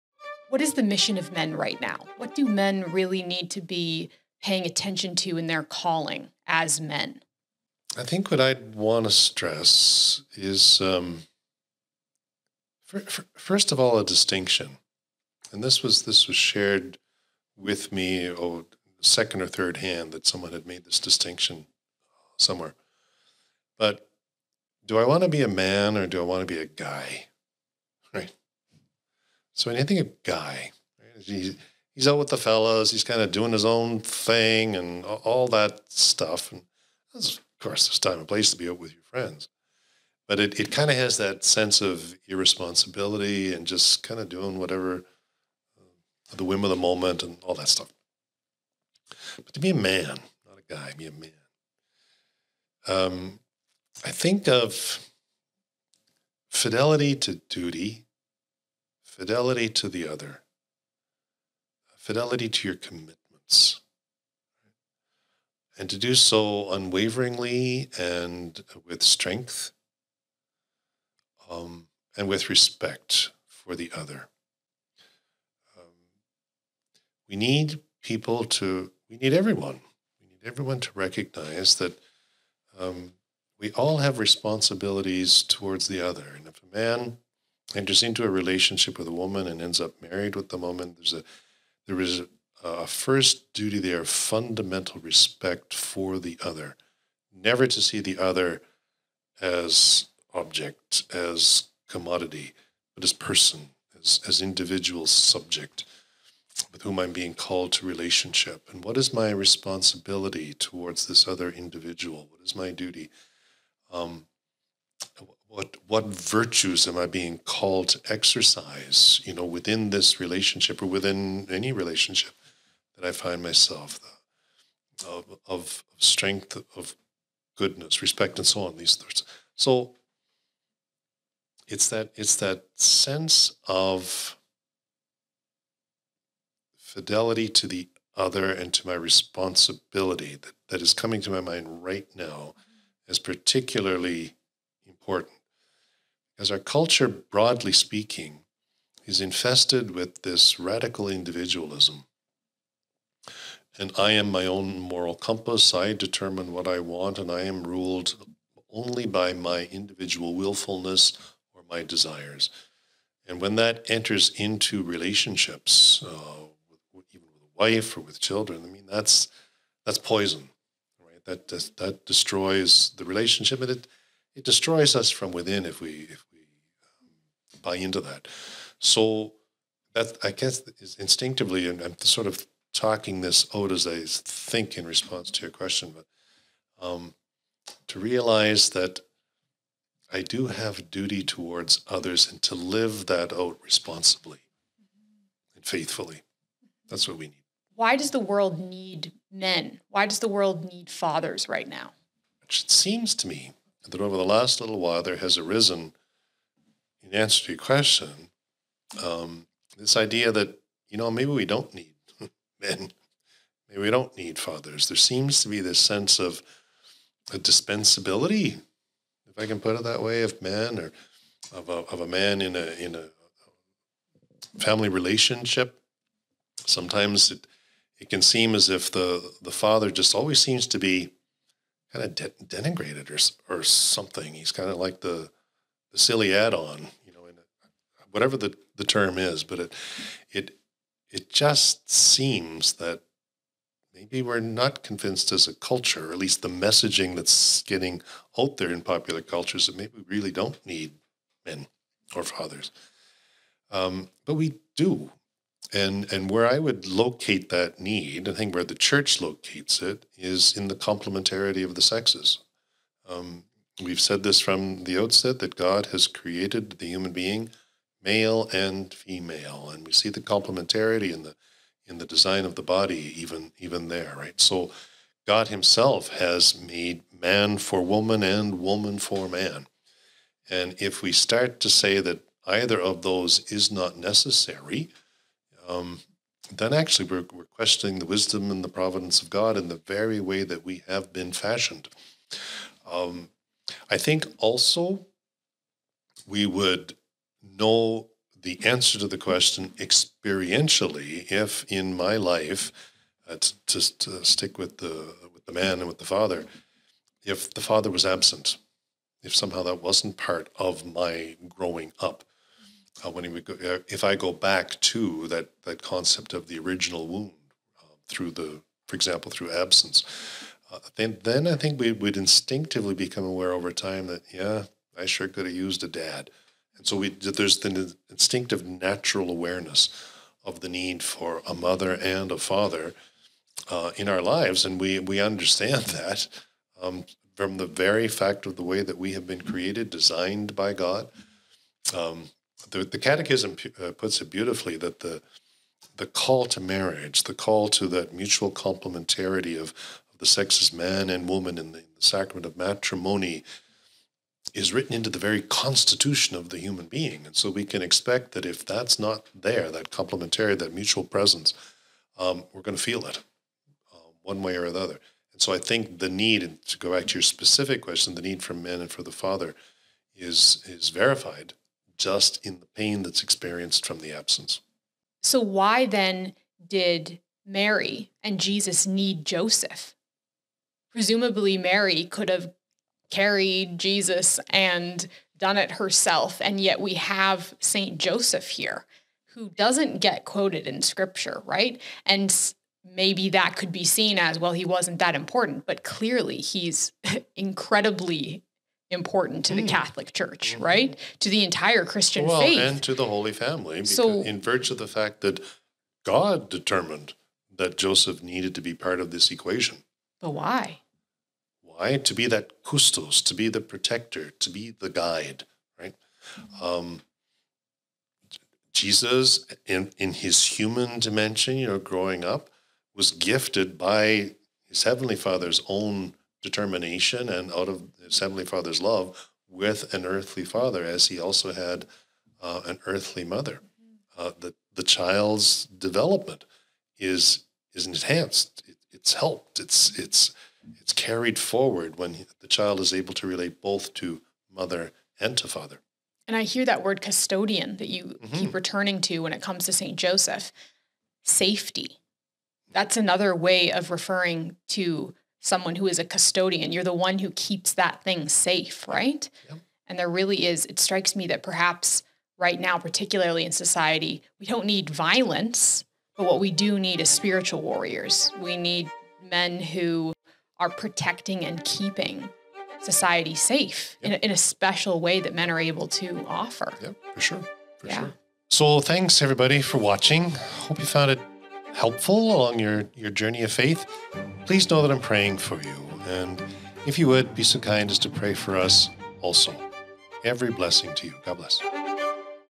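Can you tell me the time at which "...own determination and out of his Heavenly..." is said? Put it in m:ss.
7:05.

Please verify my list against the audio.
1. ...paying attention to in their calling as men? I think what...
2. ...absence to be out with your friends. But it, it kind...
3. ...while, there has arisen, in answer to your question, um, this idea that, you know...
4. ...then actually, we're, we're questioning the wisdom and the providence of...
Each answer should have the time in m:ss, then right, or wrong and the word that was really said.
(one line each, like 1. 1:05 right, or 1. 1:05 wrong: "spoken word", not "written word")
1. 0:04 right
2. 0:38 wrong: "place", not "absence"
3. 3:24 right
4. 4:46 right.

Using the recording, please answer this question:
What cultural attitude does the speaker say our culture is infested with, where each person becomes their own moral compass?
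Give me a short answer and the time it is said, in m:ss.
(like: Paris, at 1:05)
radical individualism, at 2:30.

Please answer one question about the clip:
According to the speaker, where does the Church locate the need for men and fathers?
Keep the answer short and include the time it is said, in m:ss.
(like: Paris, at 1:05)
complementarity of the sexes, at 4:20.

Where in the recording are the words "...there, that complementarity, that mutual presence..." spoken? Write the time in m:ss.
5:59.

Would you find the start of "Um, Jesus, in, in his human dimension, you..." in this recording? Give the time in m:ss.
6:56.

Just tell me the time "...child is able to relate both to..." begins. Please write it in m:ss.
7:22.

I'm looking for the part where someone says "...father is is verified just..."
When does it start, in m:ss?
6:09.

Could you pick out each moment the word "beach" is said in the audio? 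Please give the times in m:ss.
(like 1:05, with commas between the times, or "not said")
not said.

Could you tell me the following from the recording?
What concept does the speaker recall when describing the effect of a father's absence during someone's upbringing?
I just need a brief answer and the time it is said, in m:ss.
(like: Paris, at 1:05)
original wound, at 5:16.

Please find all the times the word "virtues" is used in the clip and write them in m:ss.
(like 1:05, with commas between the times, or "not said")
1:56, 6:44.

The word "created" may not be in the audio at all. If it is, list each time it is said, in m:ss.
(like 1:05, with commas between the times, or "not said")
4:26, 5:39.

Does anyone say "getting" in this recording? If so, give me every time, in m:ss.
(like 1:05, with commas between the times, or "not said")
4:07.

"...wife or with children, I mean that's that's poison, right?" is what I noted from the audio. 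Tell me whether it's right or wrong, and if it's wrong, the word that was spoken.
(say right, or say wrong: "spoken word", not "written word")
right.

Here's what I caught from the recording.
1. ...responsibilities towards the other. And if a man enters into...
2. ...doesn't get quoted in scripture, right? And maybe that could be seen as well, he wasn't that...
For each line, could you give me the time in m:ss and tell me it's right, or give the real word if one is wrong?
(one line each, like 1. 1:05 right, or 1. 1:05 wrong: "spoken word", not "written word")
1. 1:24 right
2. 6:29 right.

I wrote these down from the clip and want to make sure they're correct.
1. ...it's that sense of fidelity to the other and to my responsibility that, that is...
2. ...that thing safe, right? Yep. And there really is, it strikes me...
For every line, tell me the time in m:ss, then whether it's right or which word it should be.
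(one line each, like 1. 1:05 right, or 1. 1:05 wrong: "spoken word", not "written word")
1. 2:12 right
2. 7:37 right.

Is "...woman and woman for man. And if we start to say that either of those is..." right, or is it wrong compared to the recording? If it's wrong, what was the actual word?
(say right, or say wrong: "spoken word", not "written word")
right.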